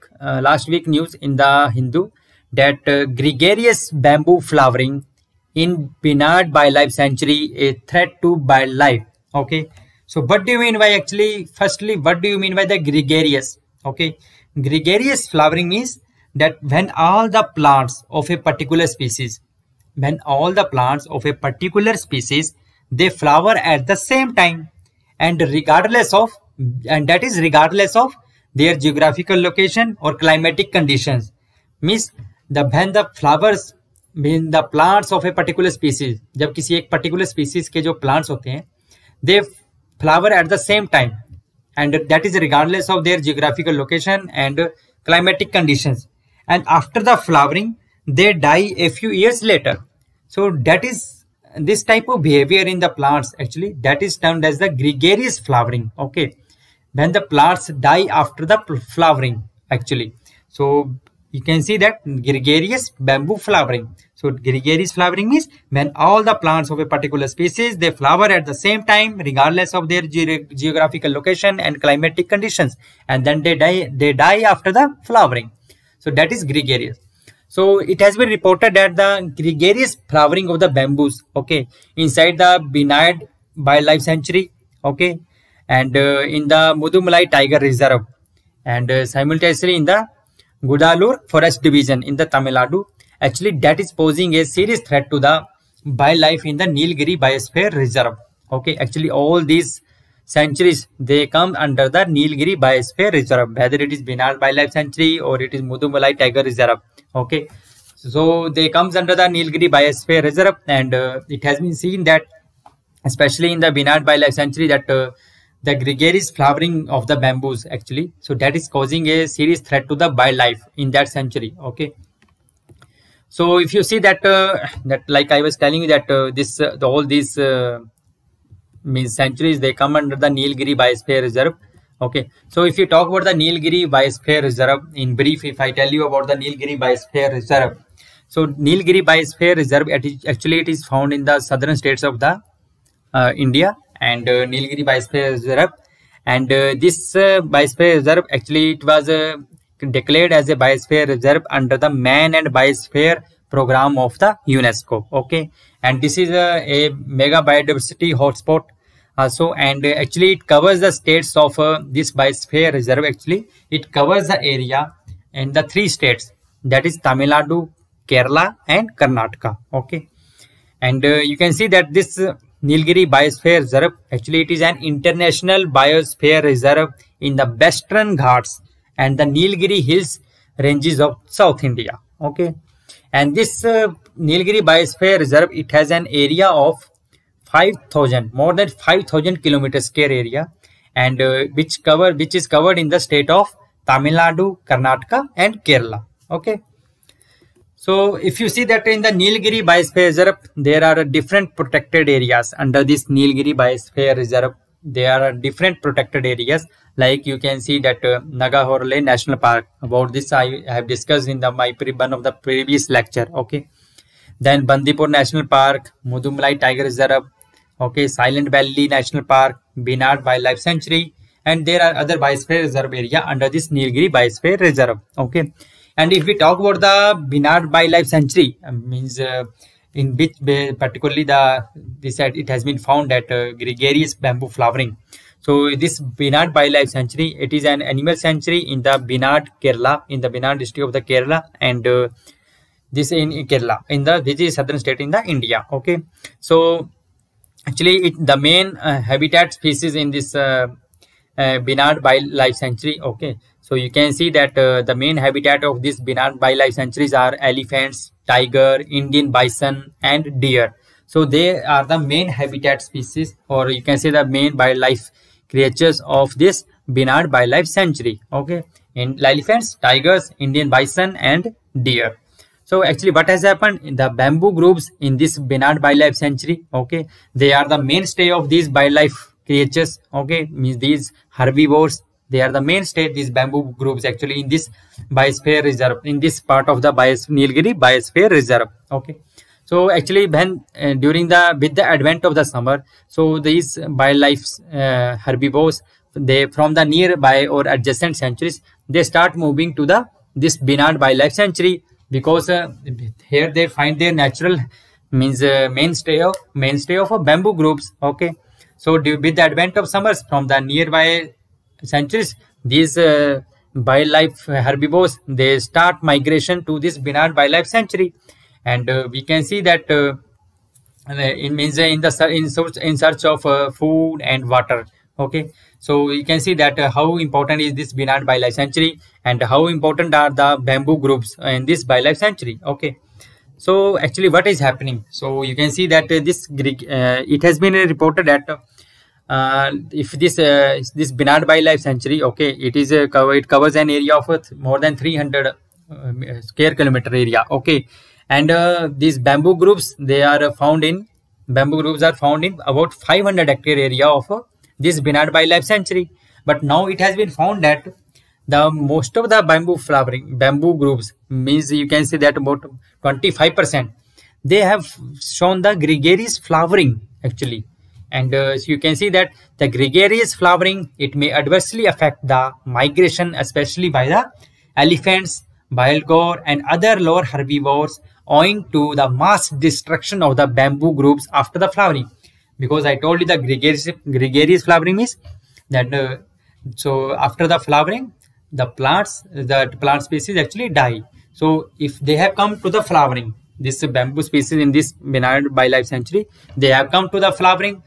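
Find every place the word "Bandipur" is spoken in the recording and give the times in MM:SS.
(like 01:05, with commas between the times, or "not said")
03:34.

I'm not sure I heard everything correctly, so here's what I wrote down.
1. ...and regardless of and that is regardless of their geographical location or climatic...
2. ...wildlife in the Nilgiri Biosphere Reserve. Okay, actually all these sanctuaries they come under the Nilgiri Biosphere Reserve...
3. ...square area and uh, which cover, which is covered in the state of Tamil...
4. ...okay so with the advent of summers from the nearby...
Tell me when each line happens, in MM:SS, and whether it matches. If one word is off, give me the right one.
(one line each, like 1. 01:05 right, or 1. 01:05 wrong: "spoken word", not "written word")
1. 00:25 right
2. 01:35 right
3. 03:09 right
4. 05:08 right.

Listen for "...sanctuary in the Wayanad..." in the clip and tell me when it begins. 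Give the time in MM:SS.
03:58.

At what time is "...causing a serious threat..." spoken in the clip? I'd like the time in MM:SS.
01:58.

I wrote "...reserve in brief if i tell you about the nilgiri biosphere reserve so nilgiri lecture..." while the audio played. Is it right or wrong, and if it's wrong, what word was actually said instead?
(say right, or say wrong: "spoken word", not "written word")
wrong: "biosphere", not "lecture".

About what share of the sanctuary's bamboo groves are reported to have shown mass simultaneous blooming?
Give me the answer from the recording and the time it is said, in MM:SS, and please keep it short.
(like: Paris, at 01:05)
25 percent, at 06:03.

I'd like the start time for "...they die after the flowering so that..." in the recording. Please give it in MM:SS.
01:14.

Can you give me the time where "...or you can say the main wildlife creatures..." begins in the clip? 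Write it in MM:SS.
04:23.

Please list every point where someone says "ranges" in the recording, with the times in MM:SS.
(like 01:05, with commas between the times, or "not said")
03:00.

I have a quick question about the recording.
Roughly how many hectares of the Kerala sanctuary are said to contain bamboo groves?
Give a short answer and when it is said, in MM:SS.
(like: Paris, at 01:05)
500 hectares, at 05:52.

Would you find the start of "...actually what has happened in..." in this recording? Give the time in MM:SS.
04:32.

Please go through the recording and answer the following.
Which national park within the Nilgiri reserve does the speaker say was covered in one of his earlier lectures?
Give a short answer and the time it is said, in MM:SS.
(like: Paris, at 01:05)
Nagarhole National Park, at 03:28.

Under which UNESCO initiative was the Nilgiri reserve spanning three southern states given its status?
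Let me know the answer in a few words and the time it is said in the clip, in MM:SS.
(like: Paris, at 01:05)
Man and Biosphere Program, at 02:31.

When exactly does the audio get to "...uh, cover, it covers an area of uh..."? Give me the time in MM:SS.
05:43.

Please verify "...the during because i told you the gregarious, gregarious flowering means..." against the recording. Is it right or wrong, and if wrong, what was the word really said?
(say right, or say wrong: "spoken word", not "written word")
wrong: "flowering", not "during".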